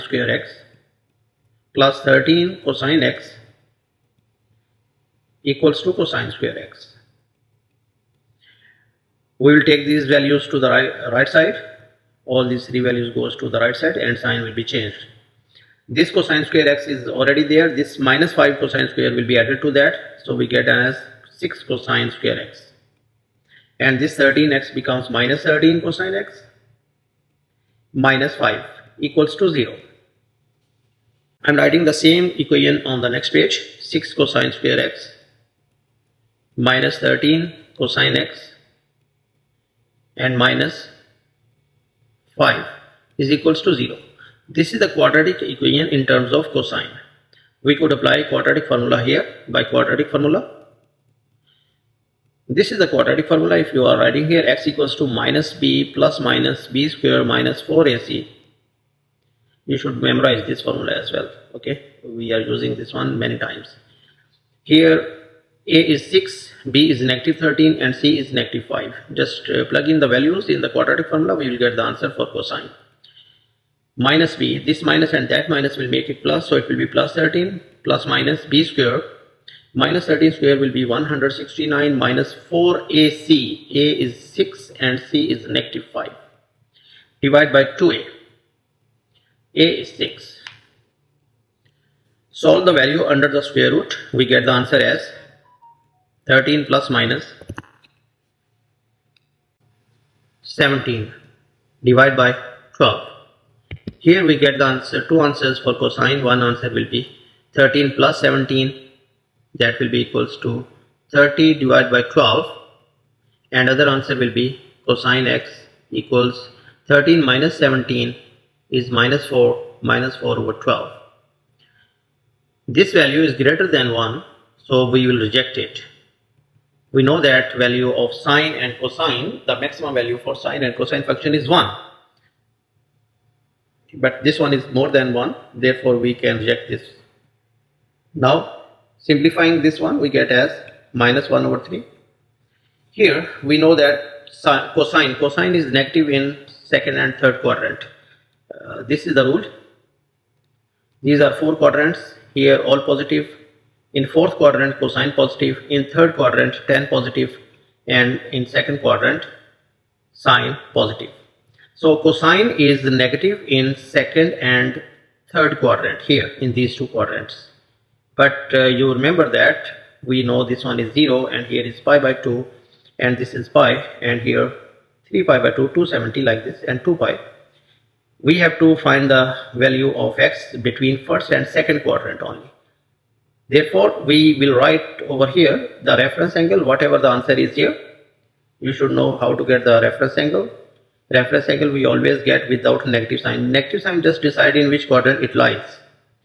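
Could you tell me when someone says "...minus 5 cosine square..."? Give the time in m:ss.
0:17.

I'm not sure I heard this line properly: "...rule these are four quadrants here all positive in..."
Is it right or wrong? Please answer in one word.
right.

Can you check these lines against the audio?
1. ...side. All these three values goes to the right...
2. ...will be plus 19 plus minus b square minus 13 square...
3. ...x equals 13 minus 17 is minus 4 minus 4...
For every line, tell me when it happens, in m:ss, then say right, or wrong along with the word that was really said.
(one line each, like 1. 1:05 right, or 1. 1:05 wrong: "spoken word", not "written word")
1. 0:11 right
2. 1:16 wrong: "13", not "19"
3. 1:55 right.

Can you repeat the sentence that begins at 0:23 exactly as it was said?
And this 13x becomes minus 13 cosine x minus 5 equals to 0.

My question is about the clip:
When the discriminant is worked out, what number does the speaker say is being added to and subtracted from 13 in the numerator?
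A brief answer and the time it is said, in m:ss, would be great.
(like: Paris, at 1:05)
17, at 1:36.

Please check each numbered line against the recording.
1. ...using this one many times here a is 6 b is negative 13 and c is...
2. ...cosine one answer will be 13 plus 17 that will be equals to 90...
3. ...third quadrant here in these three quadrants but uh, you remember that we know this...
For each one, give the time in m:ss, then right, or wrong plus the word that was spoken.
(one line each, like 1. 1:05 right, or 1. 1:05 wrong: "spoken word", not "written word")
1. 1:02 right
2. 1:45 wrong: "30", not "90"
3. 2:45 wrong: "two", not "three".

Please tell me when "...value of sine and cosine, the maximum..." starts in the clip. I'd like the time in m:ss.
2:07.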